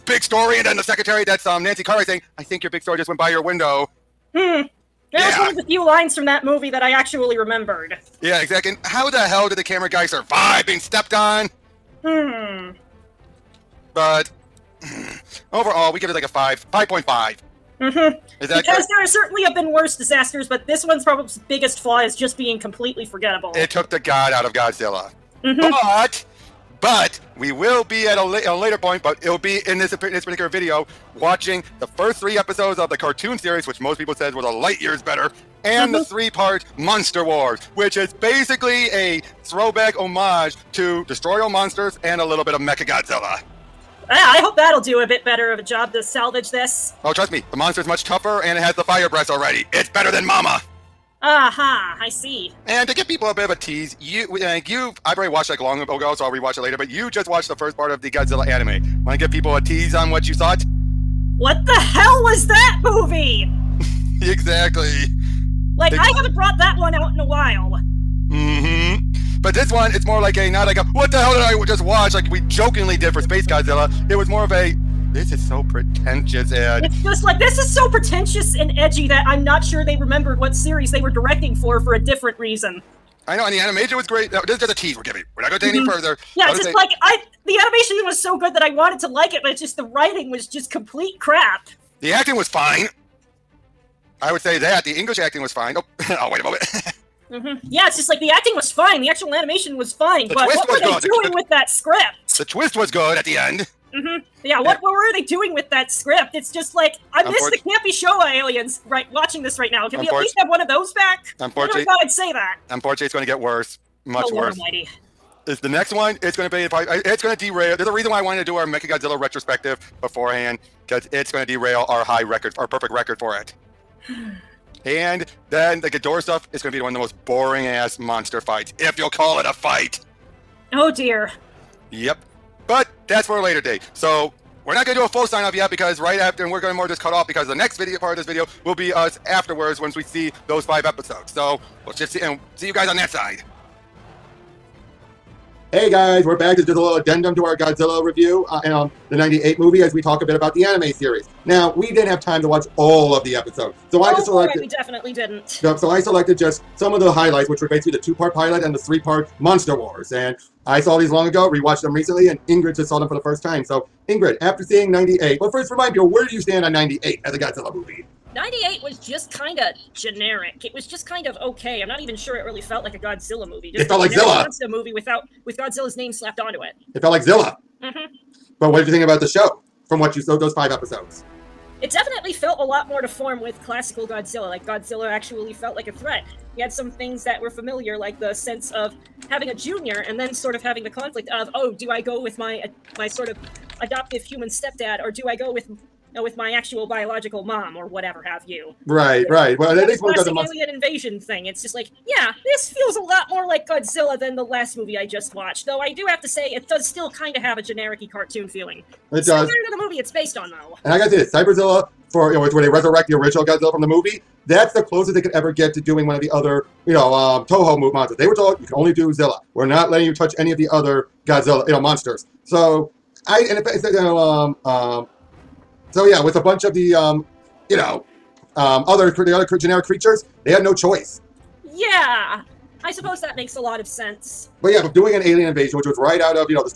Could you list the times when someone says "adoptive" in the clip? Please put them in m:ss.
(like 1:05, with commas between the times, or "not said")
3:13.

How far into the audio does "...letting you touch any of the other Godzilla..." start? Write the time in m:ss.
3:39.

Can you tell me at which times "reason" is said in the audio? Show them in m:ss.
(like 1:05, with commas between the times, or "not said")
1:22, 1:57.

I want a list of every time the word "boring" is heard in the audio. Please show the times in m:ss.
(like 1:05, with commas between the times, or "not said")
2:07.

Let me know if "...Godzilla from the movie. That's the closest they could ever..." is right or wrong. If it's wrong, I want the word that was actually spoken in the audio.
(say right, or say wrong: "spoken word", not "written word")
right.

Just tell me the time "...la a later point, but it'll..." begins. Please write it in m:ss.
0:28.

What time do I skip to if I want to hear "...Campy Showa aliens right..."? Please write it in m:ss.
1:47.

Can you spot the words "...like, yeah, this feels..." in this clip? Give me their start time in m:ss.
3:21.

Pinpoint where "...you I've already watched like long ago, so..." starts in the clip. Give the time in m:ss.
0:54.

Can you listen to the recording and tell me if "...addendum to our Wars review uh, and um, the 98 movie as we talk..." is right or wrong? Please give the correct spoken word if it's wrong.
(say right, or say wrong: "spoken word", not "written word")
wrong: "Godzilla", not "Wars".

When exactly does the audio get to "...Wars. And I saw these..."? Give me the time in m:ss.
2:39.